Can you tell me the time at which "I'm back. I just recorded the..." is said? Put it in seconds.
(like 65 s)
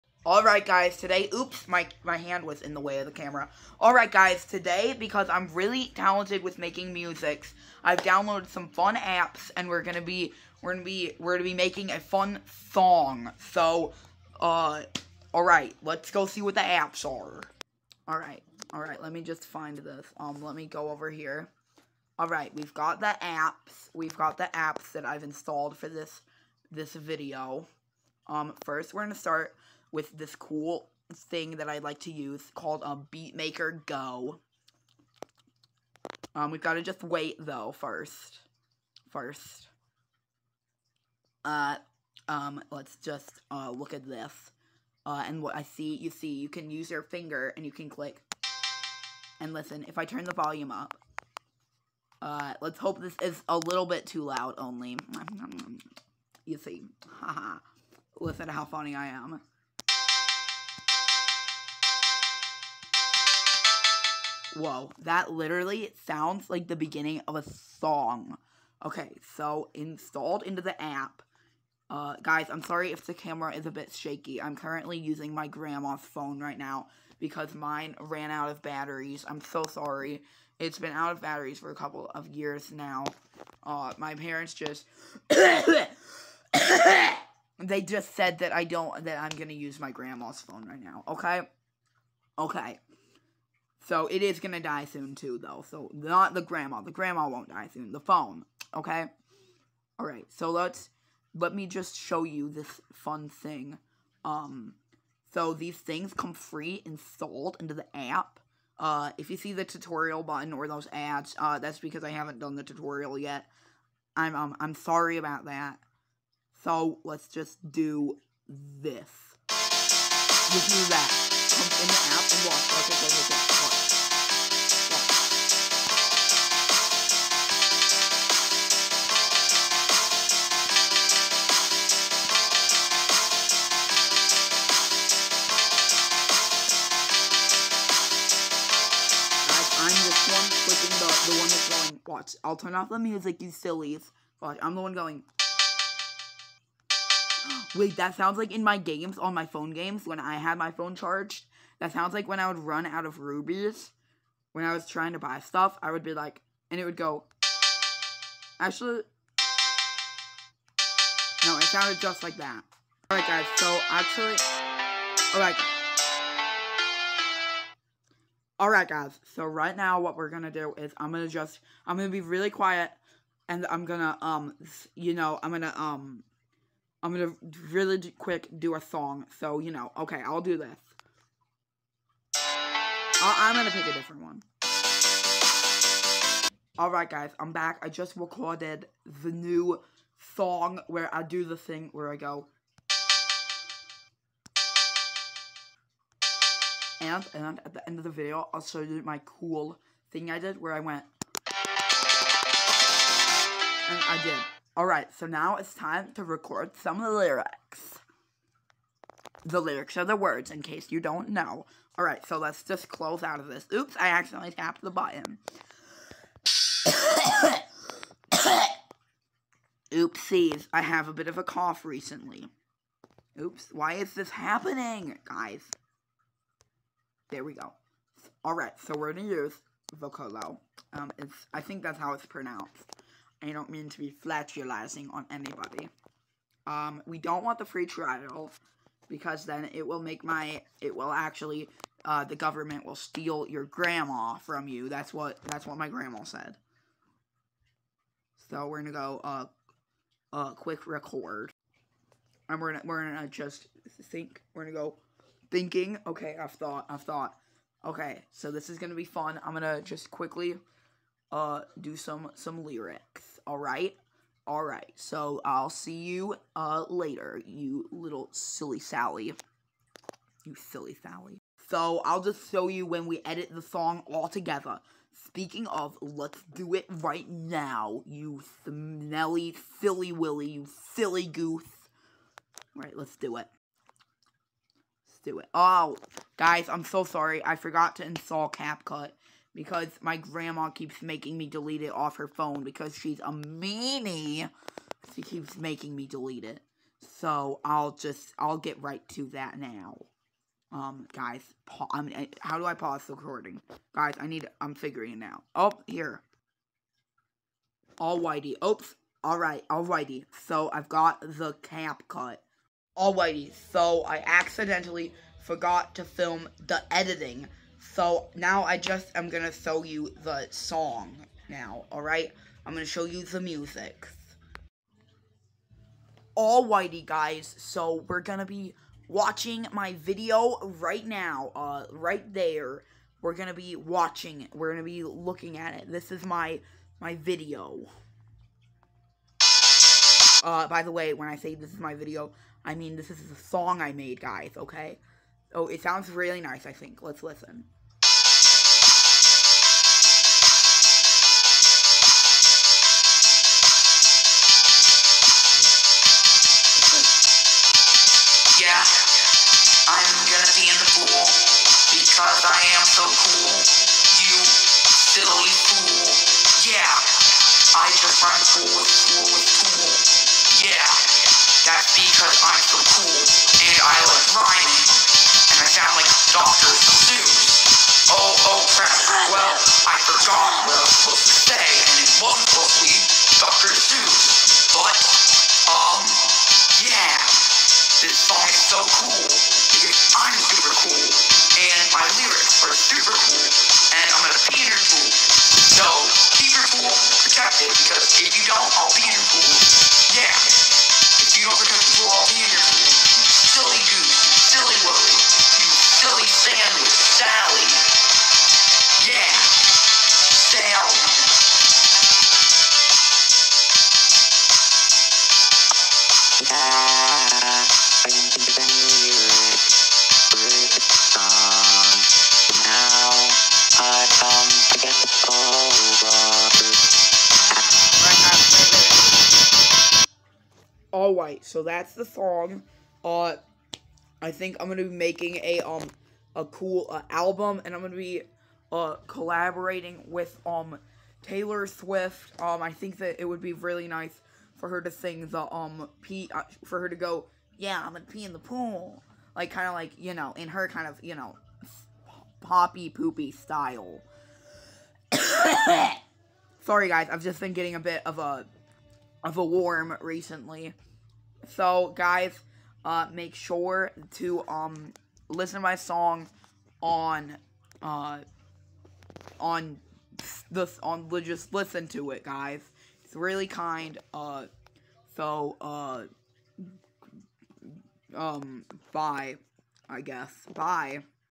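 187 s.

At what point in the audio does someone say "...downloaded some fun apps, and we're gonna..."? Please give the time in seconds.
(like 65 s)
8 s.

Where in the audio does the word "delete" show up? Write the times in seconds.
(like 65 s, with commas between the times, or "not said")
291 s, 296 s.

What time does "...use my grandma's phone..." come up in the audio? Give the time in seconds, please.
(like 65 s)
89 s.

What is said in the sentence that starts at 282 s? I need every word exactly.
All right, let's do it do it.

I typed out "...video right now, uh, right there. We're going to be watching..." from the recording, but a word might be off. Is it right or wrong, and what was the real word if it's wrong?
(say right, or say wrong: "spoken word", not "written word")
right.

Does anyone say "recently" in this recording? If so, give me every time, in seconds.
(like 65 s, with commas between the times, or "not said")
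221 s, 459 s.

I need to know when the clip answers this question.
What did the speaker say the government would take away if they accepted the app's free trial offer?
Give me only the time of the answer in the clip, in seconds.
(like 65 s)
243 s.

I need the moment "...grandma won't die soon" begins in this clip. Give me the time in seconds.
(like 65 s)
96 s.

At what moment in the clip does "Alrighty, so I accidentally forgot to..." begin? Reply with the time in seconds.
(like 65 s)
312 s.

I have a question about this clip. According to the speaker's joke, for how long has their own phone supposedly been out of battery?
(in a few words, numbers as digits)
A couple of years.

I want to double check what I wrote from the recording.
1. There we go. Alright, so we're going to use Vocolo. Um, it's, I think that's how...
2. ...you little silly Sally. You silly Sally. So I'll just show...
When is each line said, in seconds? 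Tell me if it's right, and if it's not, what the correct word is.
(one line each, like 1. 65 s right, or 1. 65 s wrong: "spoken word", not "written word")
1. 227 s right
2. 267 s right.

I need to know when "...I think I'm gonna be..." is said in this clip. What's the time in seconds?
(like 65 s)
434 s.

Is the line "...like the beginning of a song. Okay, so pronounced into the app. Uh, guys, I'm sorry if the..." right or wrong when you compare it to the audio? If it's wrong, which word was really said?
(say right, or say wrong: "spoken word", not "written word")
wrong: "installed", not "pronounced".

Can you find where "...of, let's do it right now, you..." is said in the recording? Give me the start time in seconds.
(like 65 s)
275 s.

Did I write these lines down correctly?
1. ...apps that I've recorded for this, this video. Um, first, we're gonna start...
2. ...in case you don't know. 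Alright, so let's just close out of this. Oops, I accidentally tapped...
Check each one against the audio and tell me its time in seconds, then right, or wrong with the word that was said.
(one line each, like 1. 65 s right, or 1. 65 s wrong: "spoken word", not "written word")
1. 24 s wrong: "installed", not "recorded"
2. 210 s right.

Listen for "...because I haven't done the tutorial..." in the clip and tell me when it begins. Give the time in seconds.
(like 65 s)
111 s.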